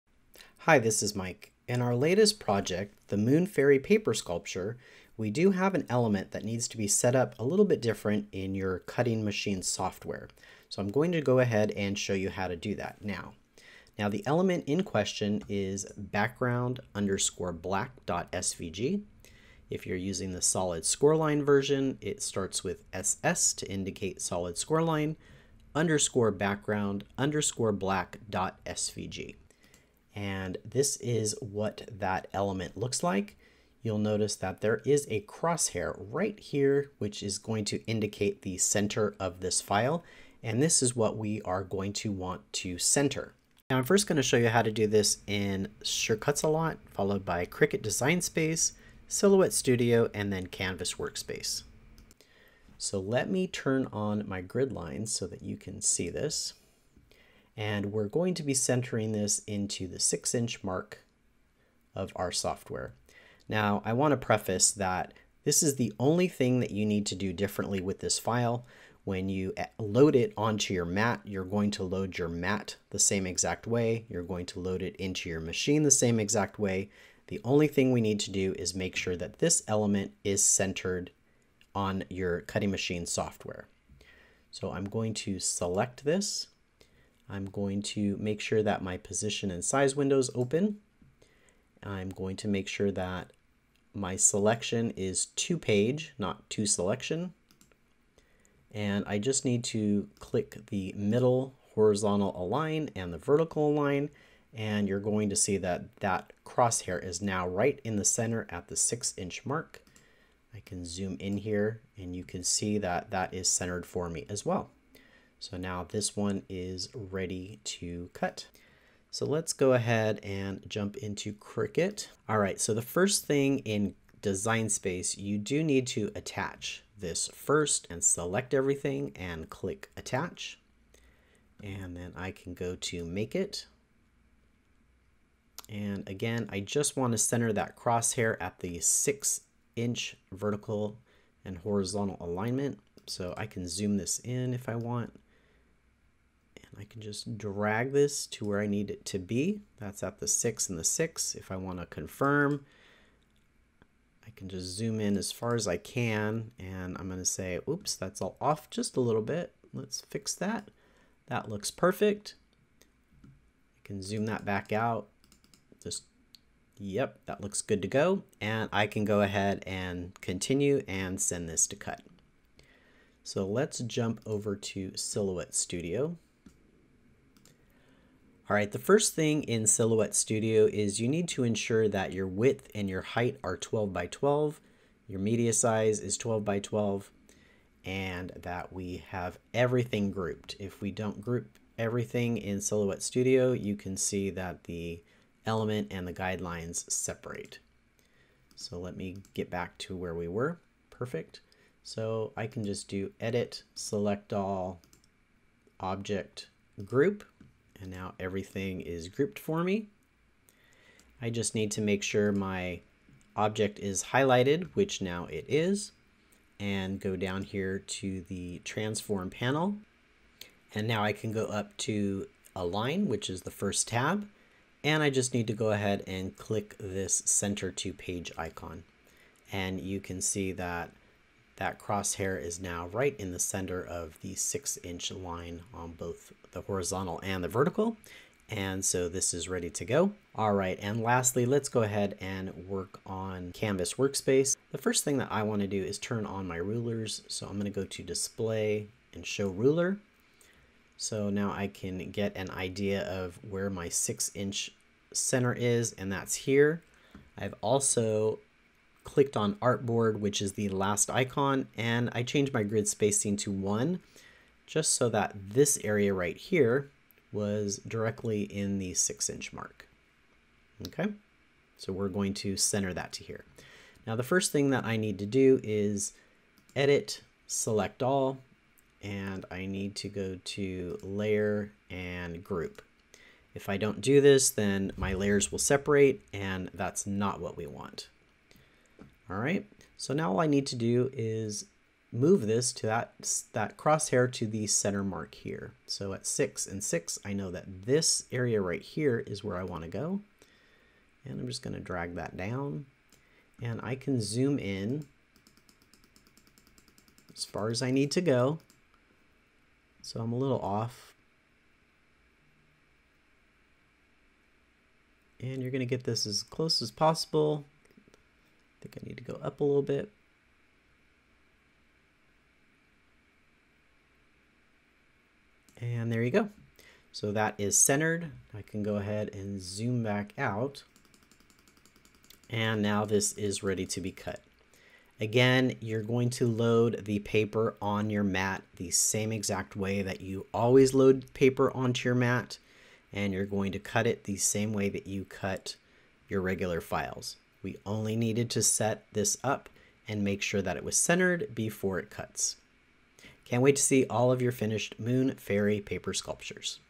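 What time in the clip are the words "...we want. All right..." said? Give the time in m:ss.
4:47.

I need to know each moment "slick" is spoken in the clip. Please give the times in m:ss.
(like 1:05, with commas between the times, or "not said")
not said.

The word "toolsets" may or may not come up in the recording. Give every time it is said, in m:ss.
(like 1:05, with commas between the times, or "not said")
not said.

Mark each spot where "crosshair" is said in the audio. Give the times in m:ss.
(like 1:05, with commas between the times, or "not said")
0:35, 1:46, 2:17, 3:51, 4:53.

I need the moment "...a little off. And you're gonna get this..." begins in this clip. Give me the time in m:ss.
5:10.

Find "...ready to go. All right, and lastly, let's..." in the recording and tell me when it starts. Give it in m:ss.
3:59.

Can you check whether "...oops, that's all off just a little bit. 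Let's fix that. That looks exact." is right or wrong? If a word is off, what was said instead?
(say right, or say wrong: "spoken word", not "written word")
wrong: "perfect", not "exact".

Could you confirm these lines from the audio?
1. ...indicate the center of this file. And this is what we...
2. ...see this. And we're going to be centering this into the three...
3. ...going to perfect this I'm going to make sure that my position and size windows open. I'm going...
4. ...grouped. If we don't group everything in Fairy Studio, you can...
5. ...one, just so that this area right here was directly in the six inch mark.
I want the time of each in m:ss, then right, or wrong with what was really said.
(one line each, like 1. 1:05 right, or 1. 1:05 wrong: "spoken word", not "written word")
1. 0:37 right
2. 0:55 wrong: "six", not "three"
3. 1:24 wrong: "select", not "perfect"
4. 3:10 wrong: "Silhouette", not "Fairy"
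5. 4:23 right.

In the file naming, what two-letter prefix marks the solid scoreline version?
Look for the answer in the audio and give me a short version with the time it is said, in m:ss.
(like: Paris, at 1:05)
SS, at 0:22.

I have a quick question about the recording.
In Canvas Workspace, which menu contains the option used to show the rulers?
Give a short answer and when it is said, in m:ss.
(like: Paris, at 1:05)
Display, at 4:08.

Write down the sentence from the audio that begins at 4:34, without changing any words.
Now the first thing that I need to do is edit, select all, and I need to go to layer and group.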